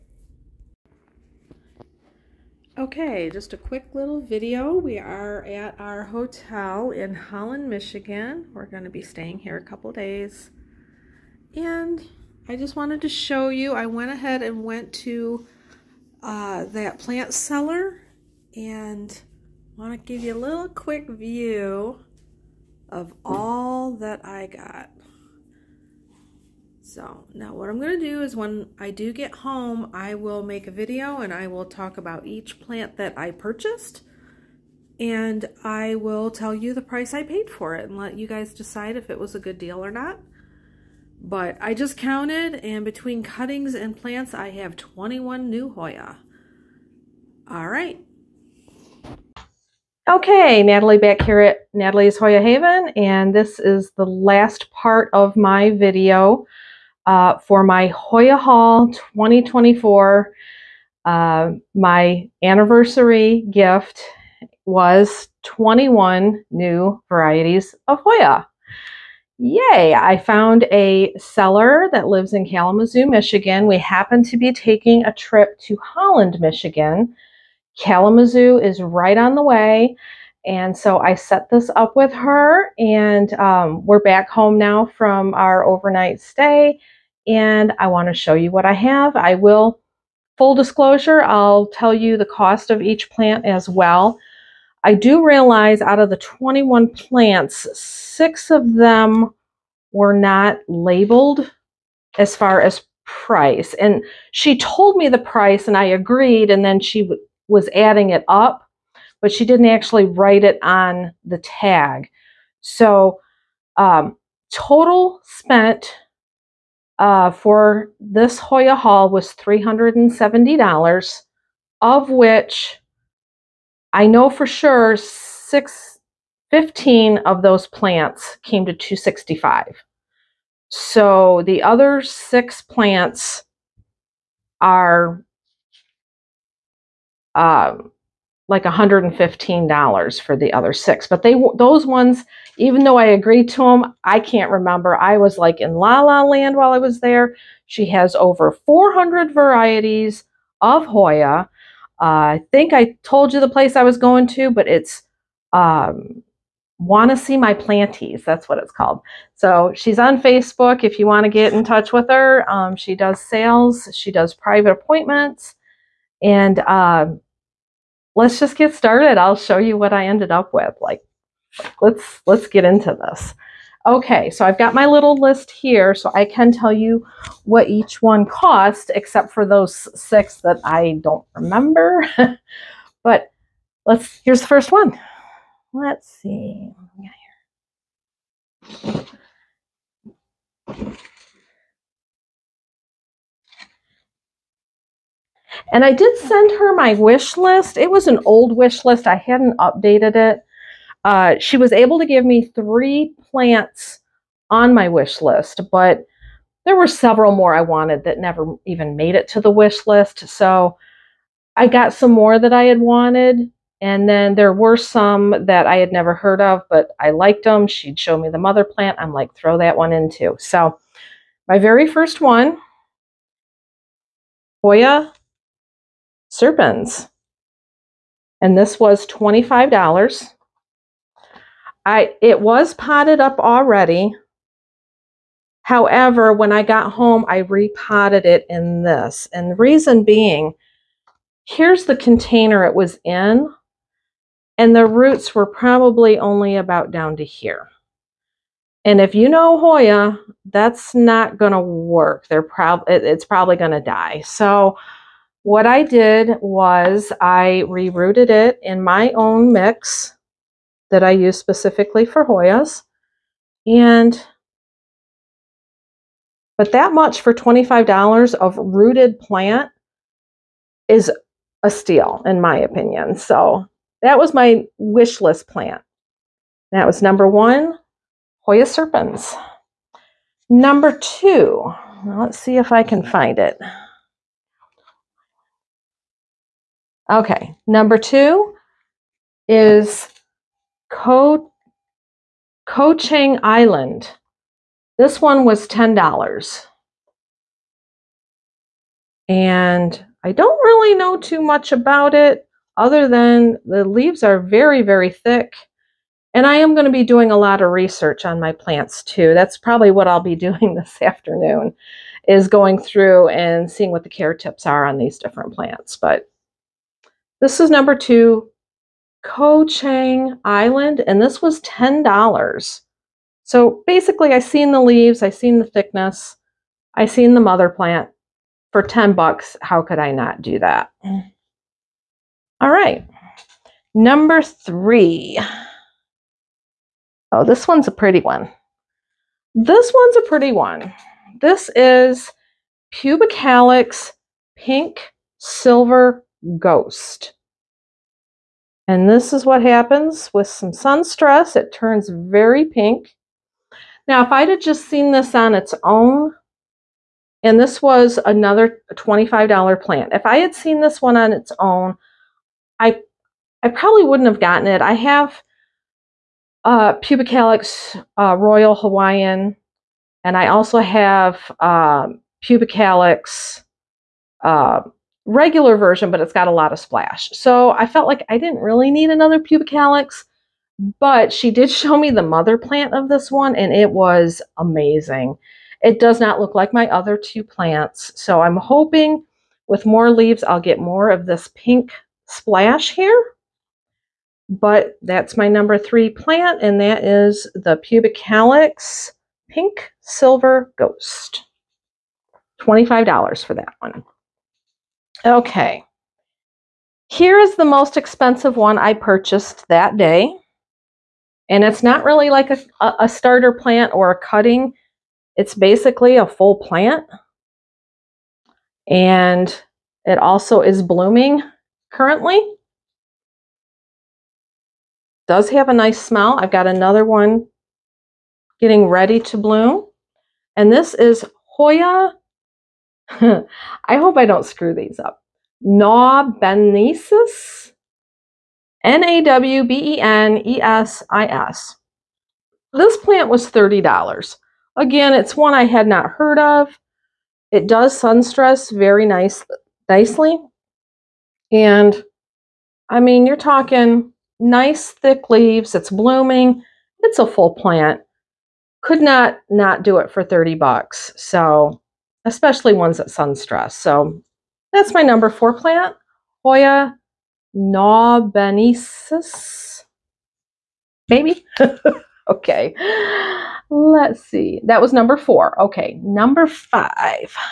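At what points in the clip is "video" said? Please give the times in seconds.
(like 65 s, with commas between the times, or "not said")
4 s, 30 s, 55 s.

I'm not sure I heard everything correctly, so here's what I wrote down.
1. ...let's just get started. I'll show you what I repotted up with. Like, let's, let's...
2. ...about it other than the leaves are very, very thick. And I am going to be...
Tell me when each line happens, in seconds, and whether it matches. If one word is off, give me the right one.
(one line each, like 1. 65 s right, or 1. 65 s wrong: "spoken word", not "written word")
1. 168 s wrong: "ended", not "repotted"
2. 301 s right.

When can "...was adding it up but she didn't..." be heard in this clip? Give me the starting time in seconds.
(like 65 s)
107 s.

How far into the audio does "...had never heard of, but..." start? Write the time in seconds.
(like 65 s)
215 s.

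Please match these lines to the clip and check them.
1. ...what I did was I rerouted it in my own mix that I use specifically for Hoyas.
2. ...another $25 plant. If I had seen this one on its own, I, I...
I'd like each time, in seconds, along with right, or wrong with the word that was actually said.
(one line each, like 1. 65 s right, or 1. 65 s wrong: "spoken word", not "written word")
1. 255 s right
2. 358 s right.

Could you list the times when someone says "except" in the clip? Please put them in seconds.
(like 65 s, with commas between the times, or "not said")
178 s.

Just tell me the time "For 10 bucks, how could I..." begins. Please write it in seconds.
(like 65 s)
328 s.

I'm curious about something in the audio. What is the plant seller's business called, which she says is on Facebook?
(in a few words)
Want to See My Planties.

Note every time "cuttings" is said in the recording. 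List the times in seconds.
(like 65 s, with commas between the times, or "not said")
43 s, 414 s.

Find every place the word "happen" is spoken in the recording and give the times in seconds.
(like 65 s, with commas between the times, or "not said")
73 s, 349 s.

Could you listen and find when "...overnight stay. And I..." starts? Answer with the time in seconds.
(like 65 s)
85 s.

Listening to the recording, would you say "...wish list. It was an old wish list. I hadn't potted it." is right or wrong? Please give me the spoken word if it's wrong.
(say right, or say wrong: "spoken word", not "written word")
wrong: "updated", not "potted".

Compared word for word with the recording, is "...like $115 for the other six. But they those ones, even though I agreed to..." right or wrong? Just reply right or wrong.
right.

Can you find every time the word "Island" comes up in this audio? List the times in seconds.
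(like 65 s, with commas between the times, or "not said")
293 s, 320 s.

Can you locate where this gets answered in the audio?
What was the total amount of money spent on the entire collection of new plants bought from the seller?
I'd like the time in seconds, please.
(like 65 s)
119 s.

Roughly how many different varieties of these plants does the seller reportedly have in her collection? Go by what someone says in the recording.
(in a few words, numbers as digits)
over 400.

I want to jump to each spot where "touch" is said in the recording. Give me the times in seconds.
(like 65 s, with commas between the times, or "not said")
161 s.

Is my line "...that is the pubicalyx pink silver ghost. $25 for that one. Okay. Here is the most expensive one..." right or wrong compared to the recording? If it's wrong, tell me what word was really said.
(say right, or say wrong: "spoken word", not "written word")
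right.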